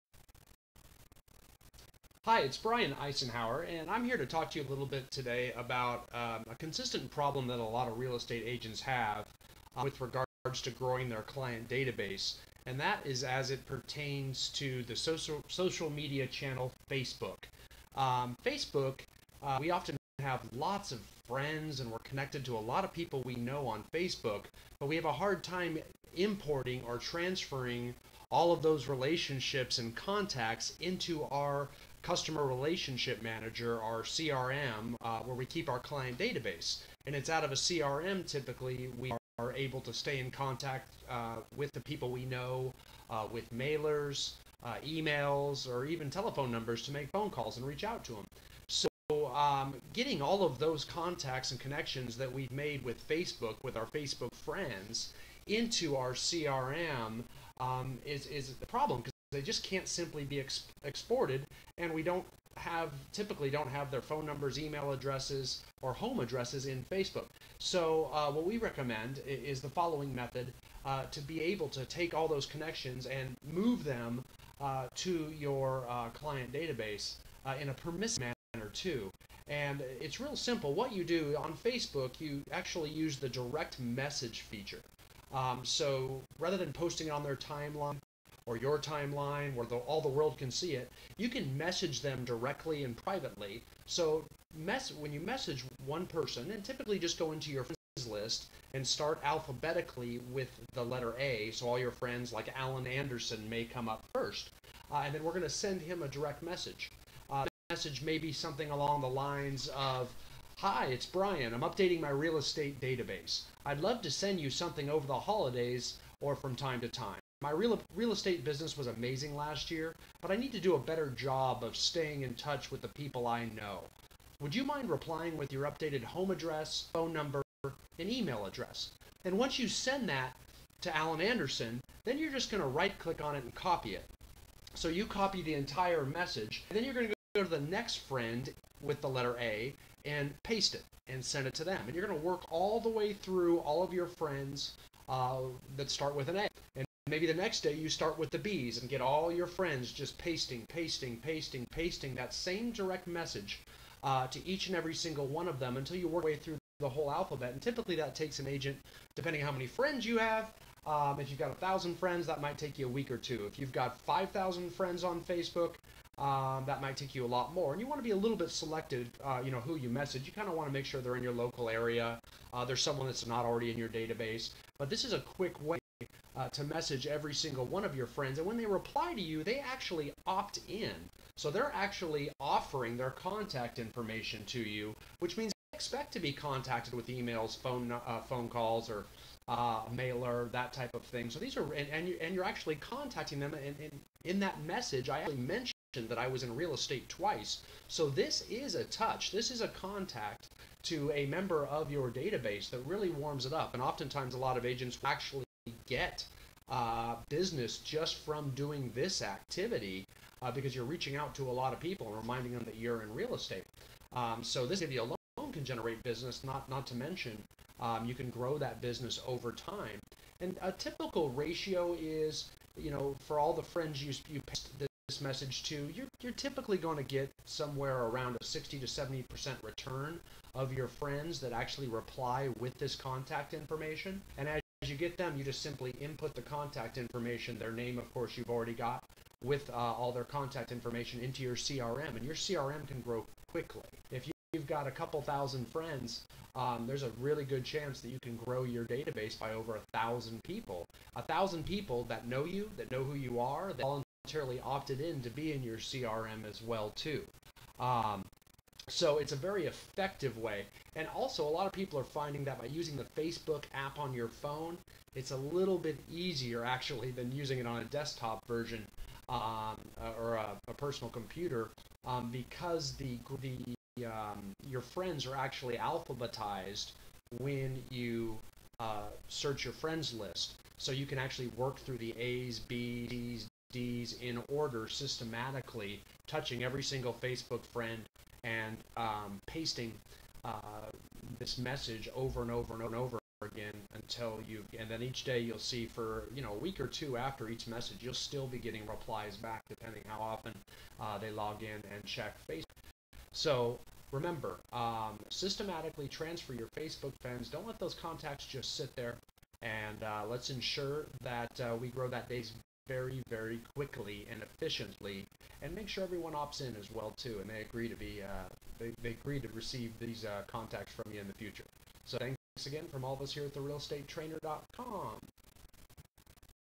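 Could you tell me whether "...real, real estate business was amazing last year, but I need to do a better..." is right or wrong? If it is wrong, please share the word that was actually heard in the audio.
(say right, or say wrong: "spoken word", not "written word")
right.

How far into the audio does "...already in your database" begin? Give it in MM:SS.
02:53.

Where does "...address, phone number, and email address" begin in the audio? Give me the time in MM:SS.
02:06.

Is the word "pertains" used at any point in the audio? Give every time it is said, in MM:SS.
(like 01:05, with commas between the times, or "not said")
00:13.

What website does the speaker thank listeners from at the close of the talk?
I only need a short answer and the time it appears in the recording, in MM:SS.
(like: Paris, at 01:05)
TheRealEstateTrainer.com, at 05:23.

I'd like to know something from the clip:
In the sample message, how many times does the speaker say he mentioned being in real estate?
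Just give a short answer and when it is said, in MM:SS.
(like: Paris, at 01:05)
twice, at 03:17.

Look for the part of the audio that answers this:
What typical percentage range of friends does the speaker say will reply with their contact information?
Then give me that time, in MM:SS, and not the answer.
03:48.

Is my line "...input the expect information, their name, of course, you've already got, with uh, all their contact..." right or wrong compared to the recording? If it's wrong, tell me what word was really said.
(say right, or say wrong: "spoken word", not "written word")
wrong: "contact", not "expect".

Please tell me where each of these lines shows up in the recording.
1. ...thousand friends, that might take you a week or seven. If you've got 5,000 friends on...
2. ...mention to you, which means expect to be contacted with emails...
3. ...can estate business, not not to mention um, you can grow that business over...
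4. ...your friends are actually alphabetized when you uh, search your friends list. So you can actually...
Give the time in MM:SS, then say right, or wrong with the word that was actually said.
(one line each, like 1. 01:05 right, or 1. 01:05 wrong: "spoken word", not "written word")
1. 02:41 wrong: "two", not "seven"
2. 03:03 wrong: "information", not "mention"
3. 03:35 wrong: "generate", not "estate"
4. 04:34 right.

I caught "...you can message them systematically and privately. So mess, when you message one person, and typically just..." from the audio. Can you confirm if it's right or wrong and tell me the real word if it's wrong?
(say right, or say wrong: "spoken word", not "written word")
wrong: "directly", not "systematically".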